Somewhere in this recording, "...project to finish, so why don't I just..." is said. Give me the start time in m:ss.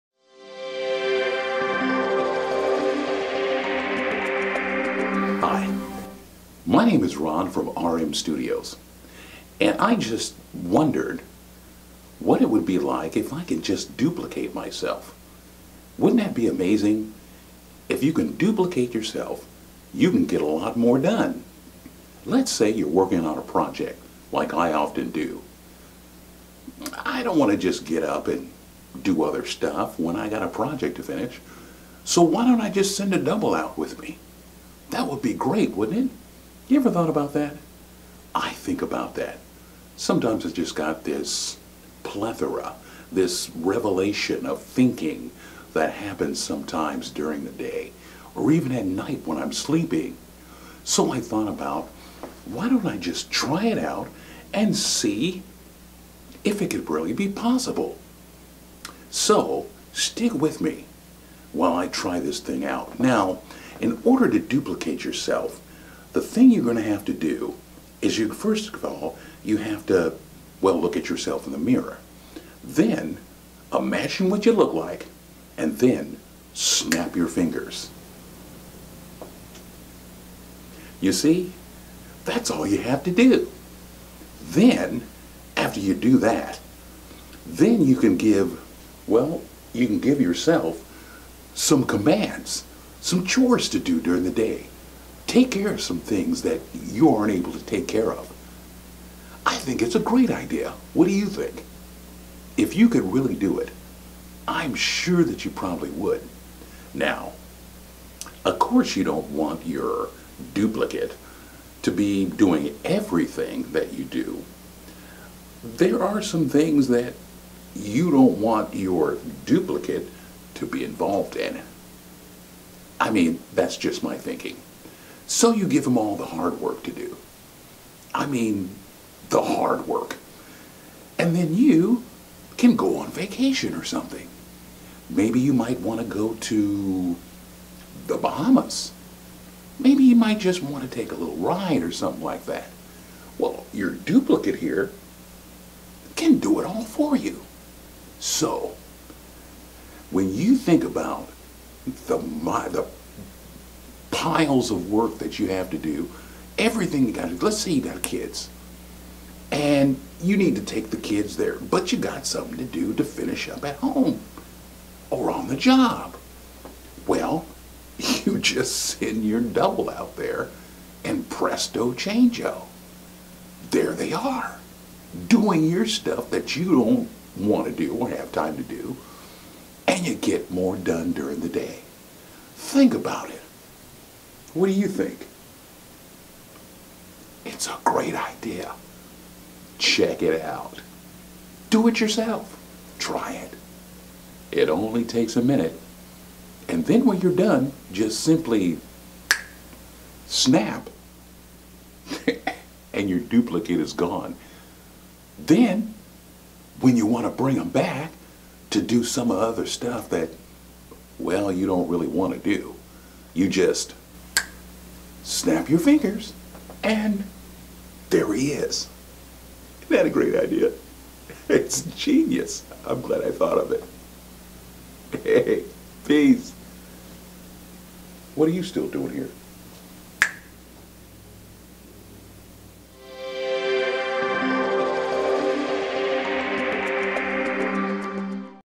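0:30.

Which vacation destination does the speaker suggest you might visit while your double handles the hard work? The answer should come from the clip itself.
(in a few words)
the Bahamas.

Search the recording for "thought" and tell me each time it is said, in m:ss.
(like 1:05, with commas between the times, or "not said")
0:36, 0:51, 3:43.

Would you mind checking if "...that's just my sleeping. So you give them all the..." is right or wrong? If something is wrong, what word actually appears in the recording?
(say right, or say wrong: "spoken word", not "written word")
wrong: "thinking", not "sleeping".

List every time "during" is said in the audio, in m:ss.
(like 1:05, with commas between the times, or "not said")
0:47, 1:33, 3:01.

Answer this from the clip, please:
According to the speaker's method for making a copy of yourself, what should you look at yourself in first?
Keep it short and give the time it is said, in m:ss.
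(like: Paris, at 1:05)
the mirror, at 1:11.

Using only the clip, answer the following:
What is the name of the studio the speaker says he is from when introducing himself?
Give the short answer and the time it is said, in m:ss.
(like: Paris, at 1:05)
RM Studios, at 0:07.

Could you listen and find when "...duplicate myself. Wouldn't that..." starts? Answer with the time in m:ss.
0:13.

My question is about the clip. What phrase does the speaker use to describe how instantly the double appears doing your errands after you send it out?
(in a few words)
presto changeo.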